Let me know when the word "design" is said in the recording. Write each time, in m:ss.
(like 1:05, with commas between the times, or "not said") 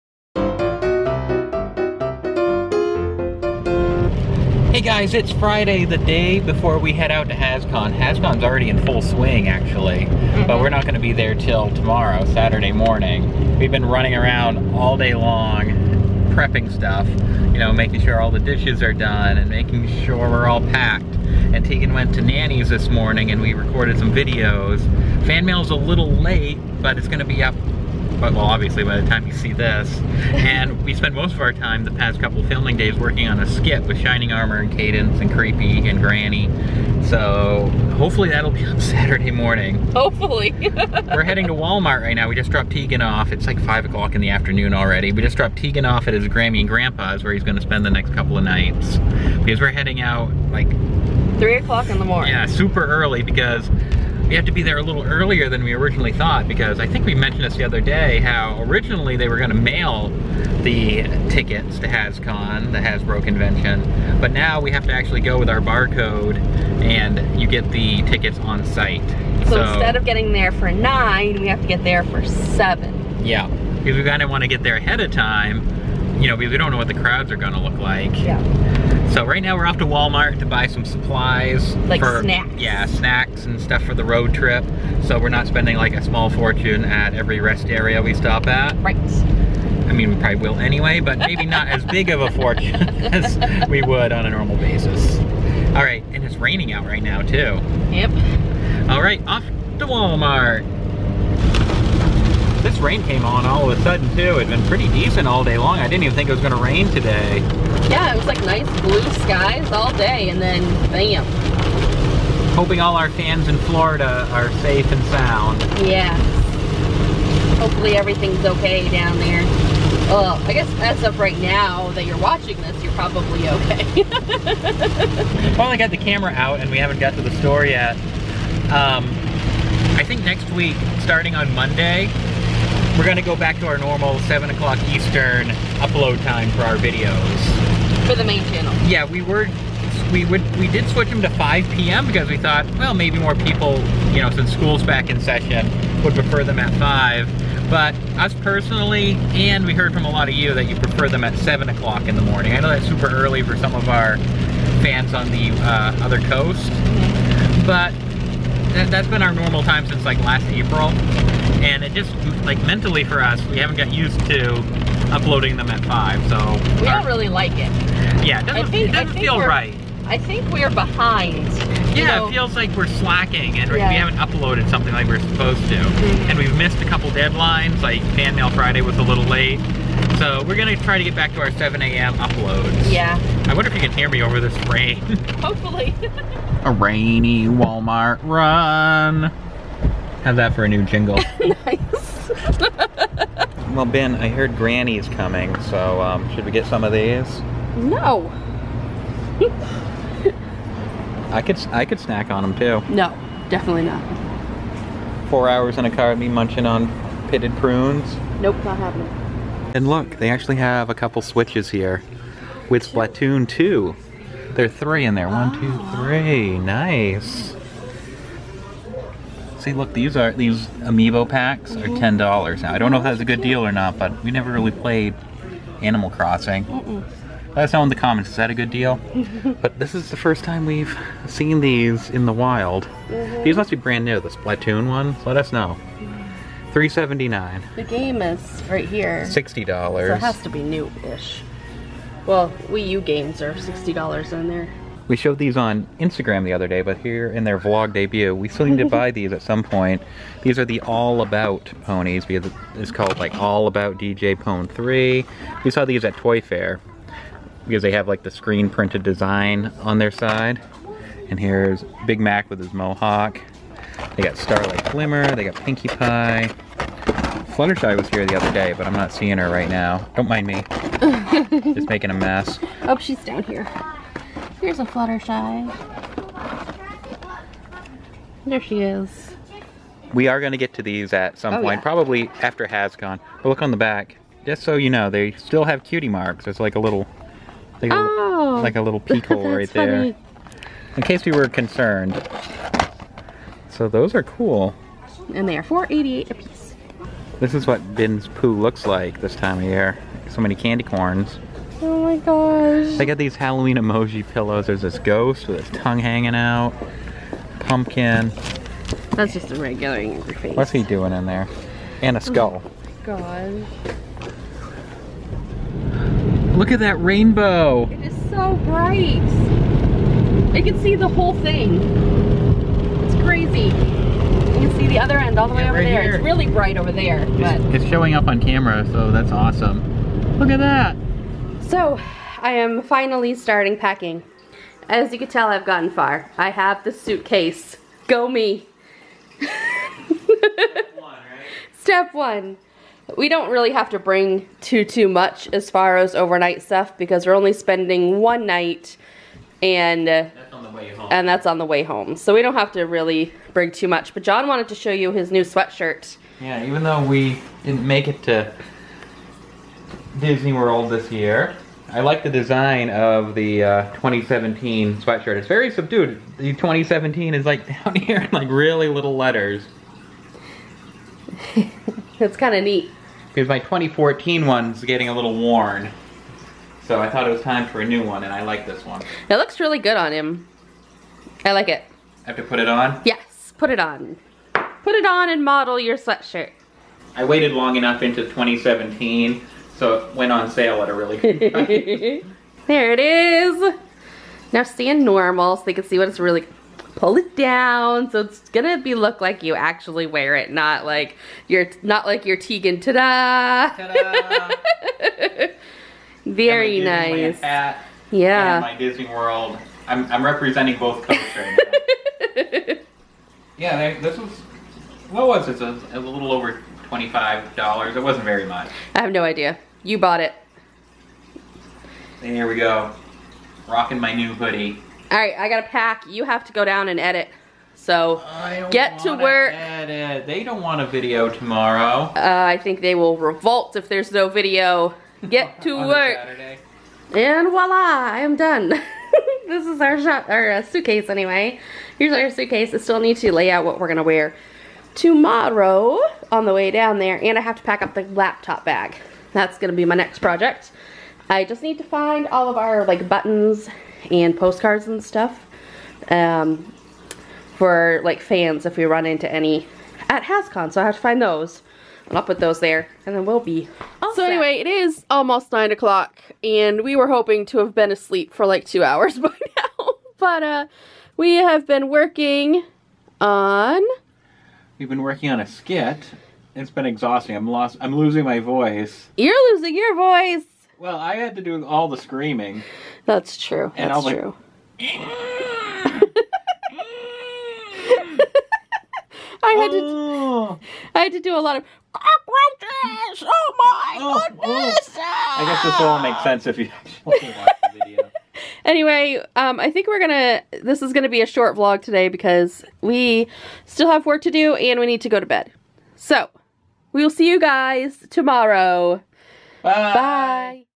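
4:19, 6:02.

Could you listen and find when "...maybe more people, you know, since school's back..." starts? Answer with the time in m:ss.
2:22.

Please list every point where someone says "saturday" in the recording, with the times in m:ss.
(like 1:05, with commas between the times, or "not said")
0:12, 0:38.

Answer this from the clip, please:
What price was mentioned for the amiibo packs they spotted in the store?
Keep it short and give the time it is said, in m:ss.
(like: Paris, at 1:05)
$10, at 3:41.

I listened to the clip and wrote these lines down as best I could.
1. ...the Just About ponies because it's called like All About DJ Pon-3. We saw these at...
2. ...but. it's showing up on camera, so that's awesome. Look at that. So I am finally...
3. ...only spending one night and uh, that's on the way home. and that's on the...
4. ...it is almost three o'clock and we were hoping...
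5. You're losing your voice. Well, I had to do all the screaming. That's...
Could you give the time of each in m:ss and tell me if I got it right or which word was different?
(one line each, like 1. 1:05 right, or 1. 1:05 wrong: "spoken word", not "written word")
1. 4:10 wrong: "All", not "Just"
2. 5:27 right
3. 5:47 right
4. 7:44 wrong: "nine", not "three"
5. 7:59 right.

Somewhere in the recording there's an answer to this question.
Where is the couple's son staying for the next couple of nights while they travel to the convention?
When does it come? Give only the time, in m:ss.
0:46.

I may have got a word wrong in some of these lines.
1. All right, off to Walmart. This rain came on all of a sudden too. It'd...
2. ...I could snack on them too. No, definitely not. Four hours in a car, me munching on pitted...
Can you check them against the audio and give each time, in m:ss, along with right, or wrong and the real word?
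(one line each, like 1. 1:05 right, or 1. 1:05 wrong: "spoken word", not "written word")
1. 1:38 right
2. 3:21 right.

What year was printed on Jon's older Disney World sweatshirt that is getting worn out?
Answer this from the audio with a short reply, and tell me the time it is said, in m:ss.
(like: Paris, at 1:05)
2014, at 6:13.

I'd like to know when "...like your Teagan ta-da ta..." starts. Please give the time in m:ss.
6:42.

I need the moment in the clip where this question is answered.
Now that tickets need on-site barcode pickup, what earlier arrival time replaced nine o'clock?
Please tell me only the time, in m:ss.
1:11.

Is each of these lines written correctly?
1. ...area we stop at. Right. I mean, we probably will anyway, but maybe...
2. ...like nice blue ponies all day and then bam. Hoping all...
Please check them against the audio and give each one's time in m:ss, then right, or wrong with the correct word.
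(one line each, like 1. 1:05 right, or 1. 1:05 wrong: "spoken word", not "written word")
1. 1:27 right
2. 1:48 wrong: "skies", not "ponies".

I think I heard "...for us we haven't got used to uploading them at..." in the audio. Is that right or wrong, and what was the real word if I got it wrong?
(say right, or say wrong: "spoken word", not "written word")
right.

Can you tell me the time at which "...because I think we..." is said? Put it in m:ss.
0:56.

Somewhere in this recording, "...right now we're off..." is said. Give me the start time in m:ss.
1:19.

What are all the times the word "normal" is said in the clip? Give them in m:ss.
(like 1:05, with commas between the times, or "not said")
1:34, 2:13, 2:39, 6:35.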